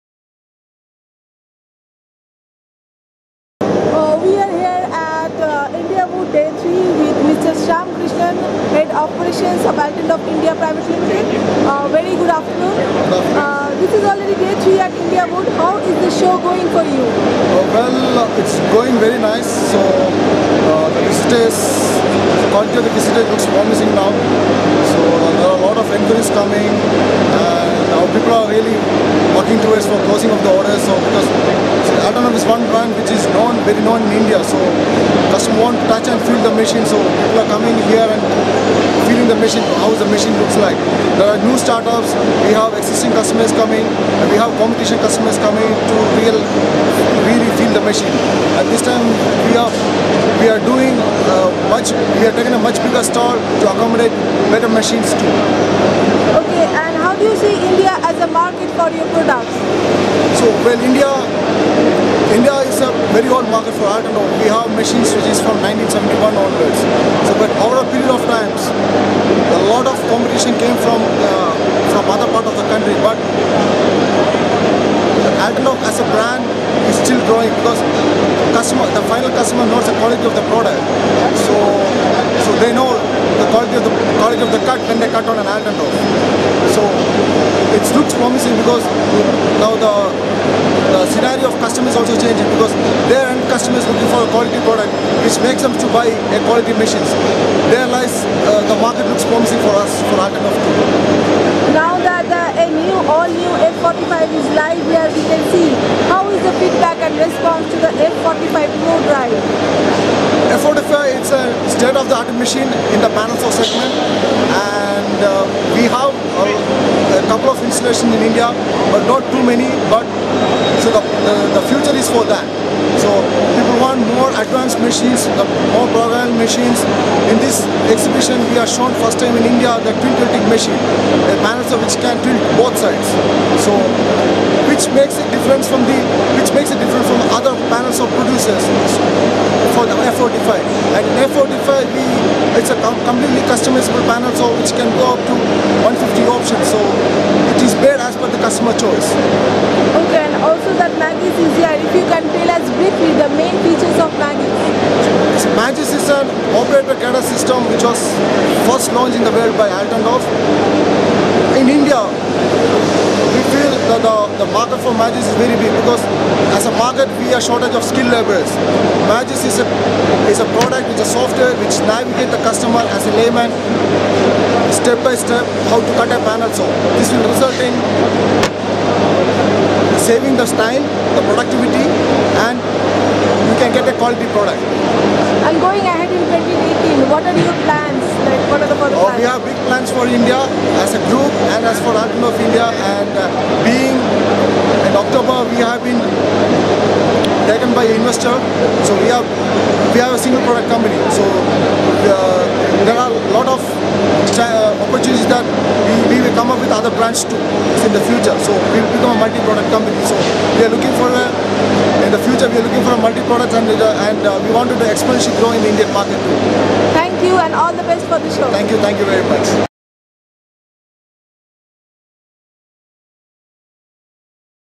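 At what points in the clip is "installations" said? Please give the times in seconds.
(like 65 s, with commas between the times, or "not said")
117 s.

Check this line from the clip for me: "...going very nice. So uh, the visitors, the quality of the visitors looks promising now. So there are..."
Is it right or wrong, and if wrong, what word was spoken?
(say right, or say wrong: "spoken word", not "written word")
right.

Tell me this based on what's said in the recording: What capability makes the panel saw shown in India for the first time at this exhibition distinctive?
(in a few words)
Twin tilting.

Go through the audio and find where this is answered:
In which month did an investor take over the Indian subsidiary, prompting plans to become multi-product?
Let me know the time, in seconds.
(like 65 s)
194 s.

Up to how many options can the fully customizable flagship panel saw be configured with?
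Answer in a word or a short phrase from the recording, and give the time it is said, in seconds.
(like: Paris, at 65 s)
150, at 145 s.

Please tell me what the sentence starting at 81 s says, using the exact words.
So, so they know the quality of the quality of the cut when they cut on an Altendorf.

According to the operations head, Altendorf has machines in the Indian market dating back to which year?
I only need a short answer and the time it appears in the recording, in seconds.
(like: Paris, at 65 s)
1971, at 65 s.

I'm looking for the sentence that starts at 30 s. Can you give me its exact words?
So because Altendorf is one brand which is known, very known in India.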